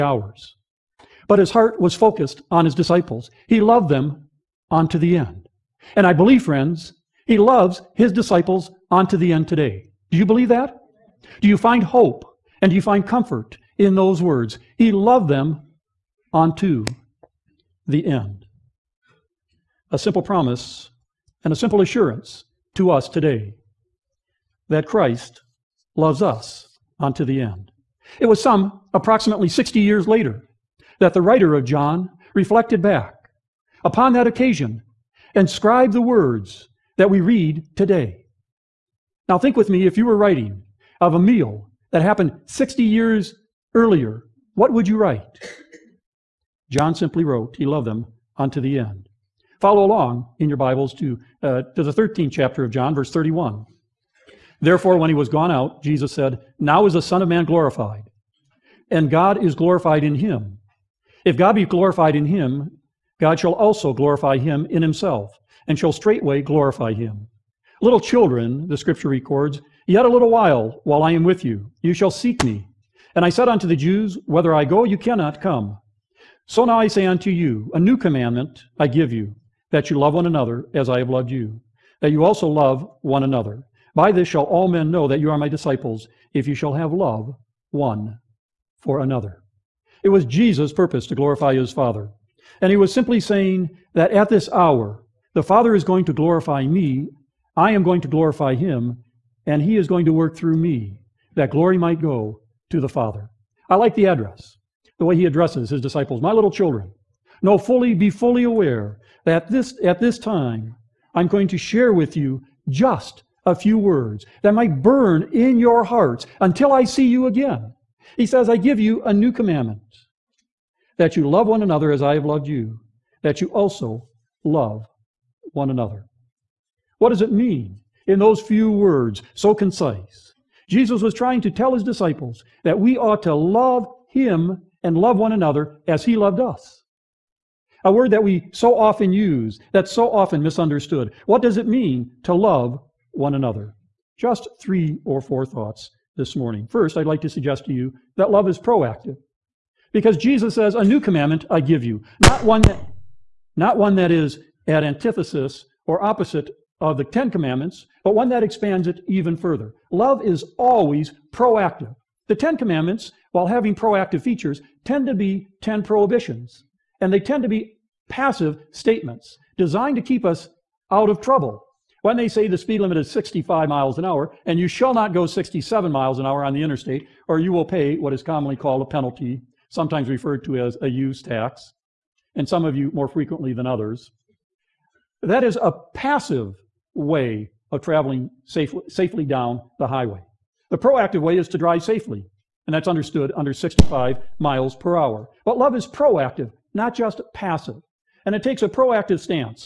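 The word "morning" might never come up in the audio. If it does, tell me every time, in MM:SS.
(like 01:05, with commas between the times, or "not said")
02:26.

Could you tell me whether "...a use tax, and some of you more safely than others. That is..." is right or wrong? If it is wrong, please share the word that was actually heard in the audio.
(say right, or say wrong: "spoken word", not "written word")
wrong: "frequently", not "safely".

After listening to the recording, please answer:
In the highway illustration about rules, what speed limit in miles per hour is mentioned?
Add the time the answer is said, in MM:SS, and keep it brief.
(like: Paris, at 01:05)
65, at 02:53.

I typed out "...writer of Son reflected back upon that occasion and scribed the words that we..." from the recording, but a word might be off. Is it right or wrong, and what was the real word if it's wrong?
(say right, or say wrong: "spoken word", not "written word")
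wrong: "John", not "Son".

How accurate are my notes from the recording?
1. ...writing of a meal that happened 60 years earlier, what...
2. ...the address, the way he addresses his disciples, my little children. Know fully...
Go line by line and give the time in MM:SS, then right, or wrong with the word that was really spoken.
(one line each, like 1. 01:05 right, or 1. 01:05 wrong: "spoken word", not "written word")
1. 00:40 right
2. 01:43 right.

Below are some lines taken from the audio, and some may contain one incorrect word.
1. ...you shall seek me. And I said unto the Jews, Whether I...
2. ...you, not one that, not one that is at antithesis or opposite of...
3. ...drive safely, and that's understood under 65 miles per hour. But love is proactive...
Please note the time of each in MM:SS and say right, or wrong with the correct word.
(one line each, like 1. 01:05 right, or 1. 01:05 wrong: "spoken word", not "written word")
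1. 01:11 right
2. 02:31 right
3. 03:11 right.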